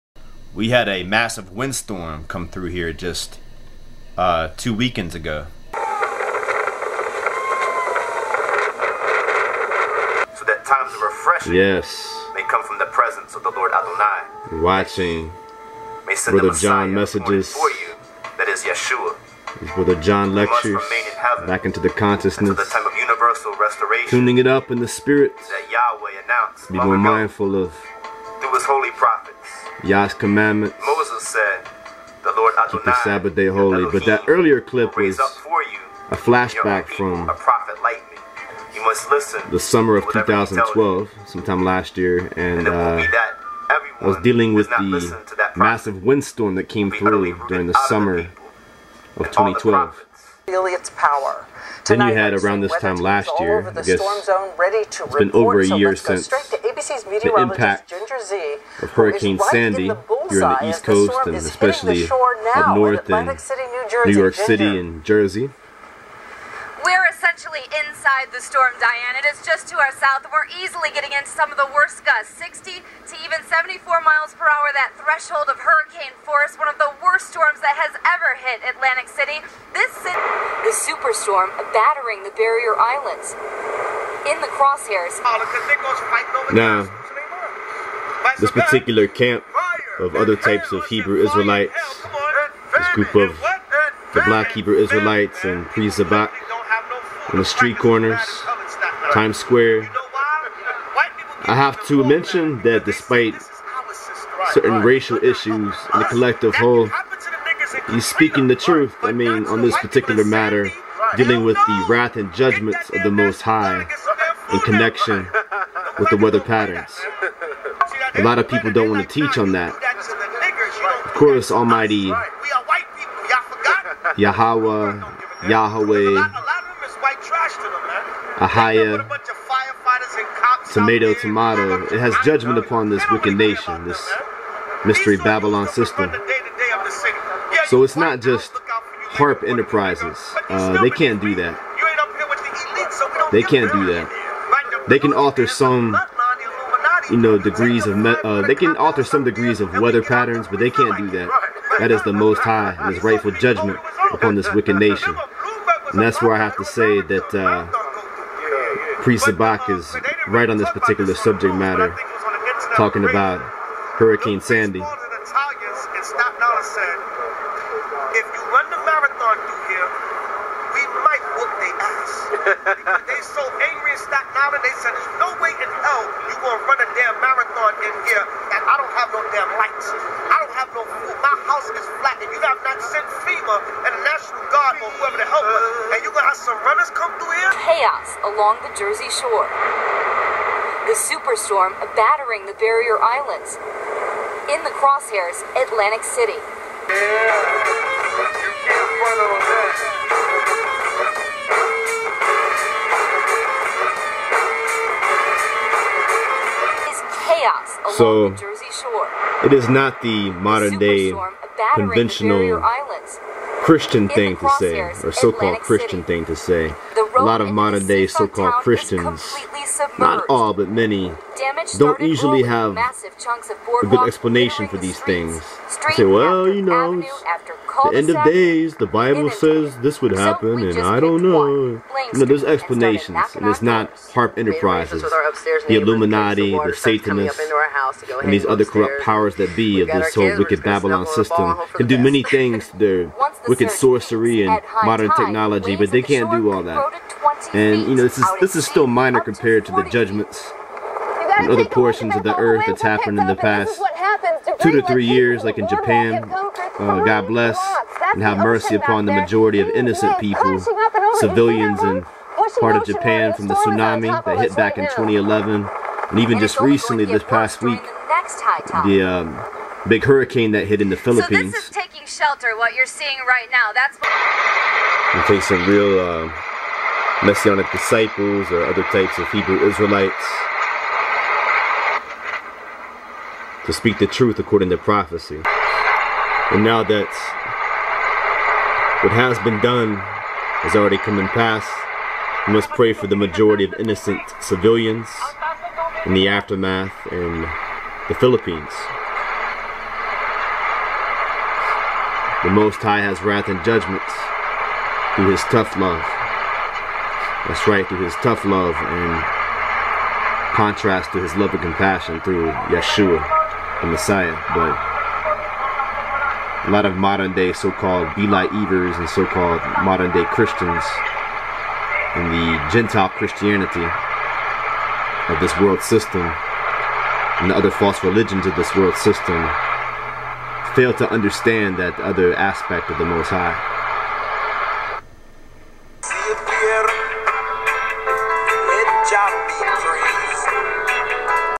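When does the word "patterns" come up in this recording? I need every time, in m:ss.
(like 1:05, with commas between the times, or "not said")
1:56, 2:30.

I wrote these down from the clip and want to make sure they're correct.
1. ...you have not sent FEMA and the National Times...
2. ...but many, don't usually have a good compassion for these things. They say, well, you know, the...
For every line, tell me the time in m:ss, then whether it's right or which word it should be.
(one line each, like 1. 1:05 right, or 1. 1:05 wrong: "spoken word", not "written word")
1. 3:02 wrong: "Guard", not "Times"
2. 3:40 wrong: "explanation", not "compassion".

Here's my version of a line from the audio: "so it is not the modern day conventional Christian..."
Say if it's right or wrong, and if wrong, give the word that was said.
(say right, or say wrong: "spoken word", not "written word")
right.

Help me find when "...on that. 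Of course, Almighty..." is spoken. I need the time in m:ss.
1:59.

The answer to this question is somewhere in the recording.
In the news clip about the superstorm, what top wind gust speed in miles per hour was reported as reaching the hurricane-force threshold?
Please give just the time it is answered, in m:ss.
1:13.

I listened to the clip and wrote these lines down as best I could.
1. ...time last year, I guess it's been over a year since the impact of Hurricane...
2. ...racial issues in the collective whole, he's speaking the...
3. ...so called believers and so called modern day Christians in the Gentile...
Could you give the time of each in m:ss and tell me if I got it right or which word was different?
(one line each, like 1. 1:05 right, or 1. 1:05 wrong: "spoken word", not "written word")
1. 0:52 right
2. 1:44 right
3. 5:17 right.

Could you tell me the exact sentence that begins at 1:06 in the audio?
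We're essentially inside the storm, Diane.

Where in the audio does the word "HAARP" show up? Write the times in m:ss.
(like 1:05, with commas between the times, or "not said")
2:19, 3:54.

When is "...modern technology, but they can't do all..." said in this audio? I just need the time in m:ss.
4:04.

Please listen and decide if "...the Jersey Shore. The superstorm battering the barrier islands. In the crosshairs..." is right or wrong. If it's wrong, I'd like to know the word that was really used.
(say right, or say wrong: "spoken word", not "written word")
right.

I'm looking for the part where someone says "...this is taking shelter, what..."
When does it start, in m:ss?
4:31.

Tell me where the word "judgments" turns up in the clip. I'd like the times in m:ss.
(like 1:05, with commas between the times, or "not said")
1:52, 2:12, 2:33, 4:09, 5:03.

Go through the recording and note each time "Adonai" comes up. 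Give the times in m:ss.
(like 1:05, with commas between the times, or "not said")
0:13, 0:32.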